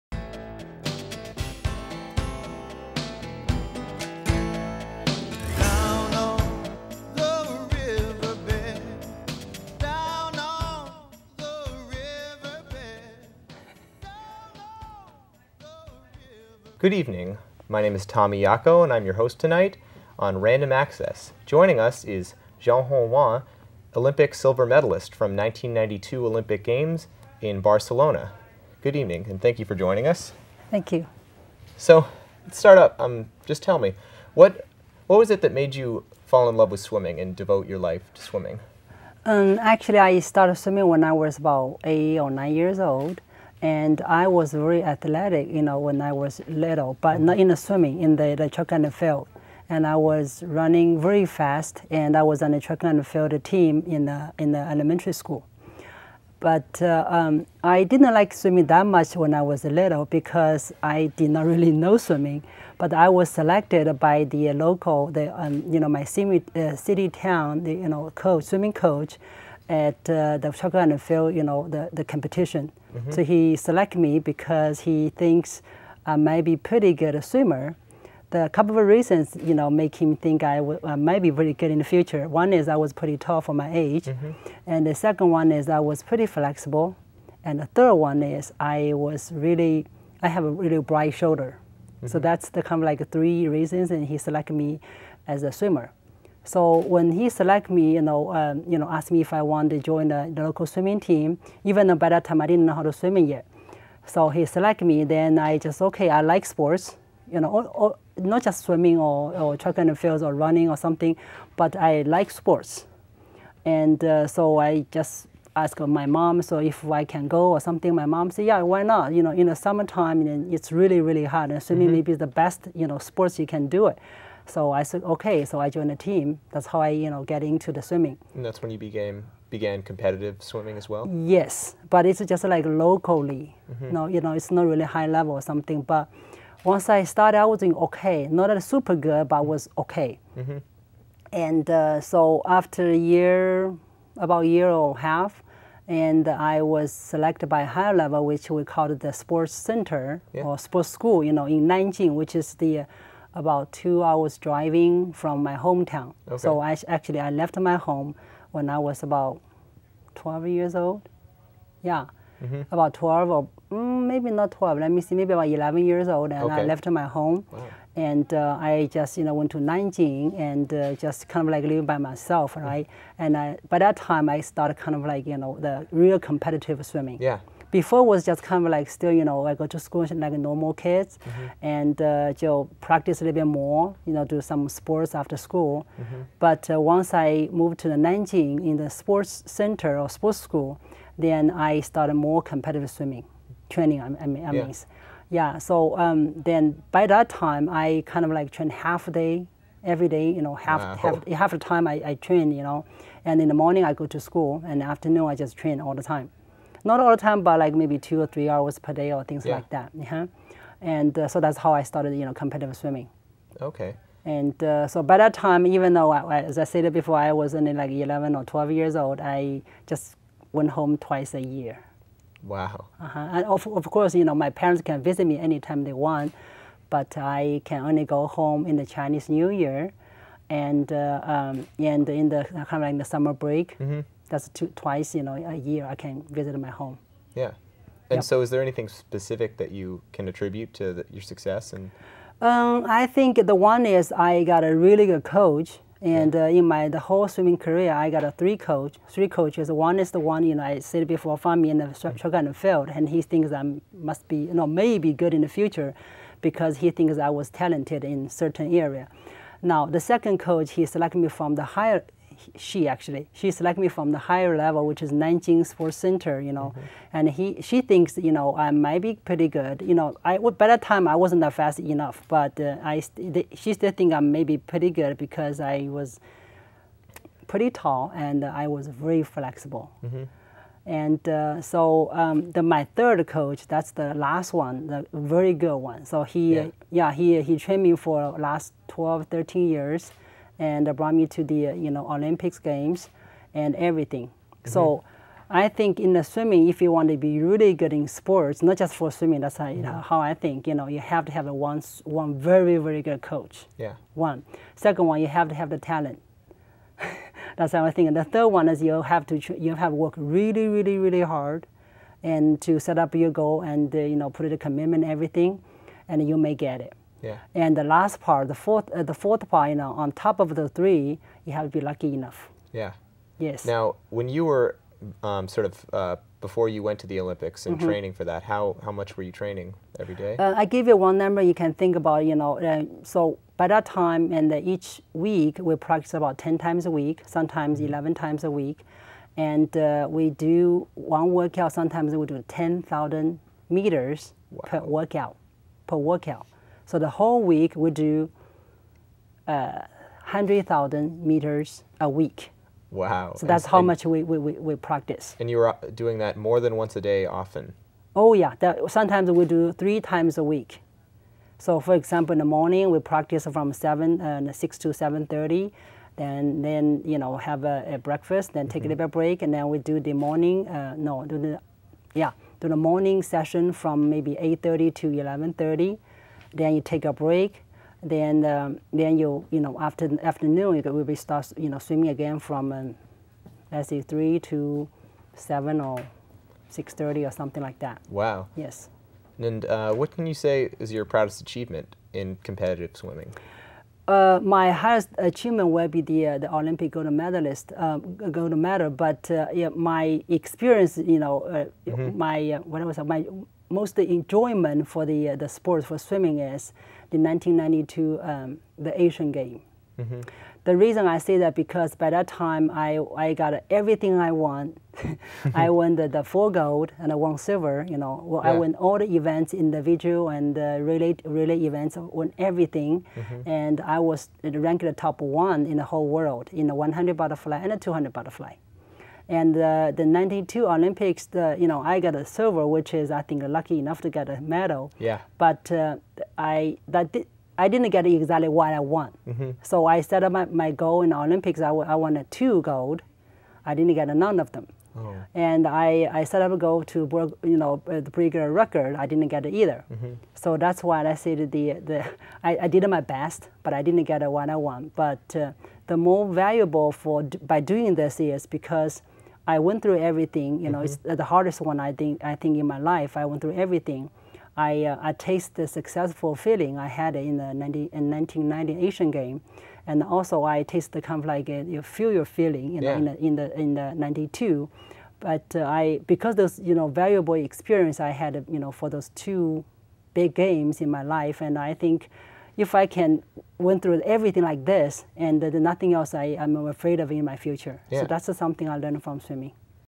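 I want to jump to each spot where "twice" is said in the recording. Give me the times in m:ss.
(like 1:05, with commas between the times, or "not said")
3:40, 3:54.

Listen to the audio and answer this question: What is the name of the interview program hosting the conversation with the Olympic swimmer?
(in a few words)
Random Access.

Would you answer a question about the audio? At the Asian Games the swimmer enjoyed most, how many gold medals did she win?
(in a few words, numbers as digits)
four.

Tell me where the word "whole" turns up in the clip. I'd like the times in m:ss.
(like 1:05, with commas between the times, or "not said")
4:06, 5:47, 7:05.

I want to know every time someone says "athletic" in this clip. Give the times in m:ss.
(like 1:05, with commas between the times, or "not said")
0:44.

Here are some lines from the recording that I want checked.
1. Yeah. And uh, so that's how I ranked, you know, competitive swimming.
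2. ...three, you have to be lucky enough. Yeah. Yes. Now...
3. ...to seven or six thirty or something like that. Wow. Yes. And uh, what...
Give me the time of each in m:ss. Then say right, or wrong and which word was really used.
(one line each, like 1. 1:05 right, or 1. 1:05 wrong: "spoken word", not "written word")
1. 3:29 wrong: "started", not "ranked"
2. 5:20 right
3. 6:24 right.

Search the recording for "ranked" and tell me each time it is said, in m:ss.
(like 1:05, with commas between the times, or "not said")
7:04.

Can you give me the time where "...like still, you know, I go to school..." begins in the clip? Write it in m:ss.
2:58.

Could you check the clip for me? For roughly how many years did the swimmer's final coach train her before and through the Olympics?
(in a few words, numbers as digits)
12, 13 years.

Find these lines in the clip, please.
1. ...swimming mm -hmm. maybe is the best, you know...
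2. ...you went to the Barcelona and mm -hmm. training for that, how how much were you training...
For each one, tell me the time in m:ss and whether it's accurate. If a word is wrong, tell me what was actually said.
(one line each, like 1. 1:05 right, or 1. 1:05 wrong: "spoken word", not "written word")
1. 2:01 right
2. 5:26 wrong: "Olympics", not "Barcelona".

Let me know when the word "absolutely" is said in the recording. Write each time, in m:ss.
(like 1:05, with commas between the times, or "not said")
not said.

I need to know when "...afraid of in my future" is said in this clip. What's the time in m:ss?
8:06.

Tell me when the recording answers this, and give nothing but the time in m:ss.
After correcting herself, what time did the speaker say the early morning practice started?
6:04.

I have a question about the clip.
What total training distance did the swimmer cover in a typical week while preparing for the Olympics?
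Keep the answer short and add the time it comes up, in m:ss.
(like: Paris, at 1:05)
100,000 meters, at 5:50.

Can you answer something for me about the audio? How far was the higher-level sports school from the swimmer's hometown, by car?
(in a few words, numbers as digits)
about two hours.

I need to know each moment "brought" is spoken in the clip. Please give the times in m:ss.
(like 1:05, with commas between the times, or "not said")
4:50.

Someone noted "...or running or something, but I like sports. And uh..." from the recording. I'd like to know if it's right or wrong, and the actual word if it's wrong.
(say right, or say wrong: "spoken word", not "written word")
right.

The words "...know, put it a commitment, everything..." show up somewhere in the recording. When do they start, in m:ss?
5:14.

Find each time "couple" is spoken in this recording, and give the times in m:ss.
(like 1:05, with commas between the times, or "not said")
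1:18.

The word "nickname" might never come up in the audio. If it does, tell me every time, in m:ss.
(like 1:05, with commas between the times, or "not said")
not said.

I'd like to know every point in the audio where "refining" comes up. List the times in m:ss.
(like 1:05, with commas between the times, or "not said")
not said.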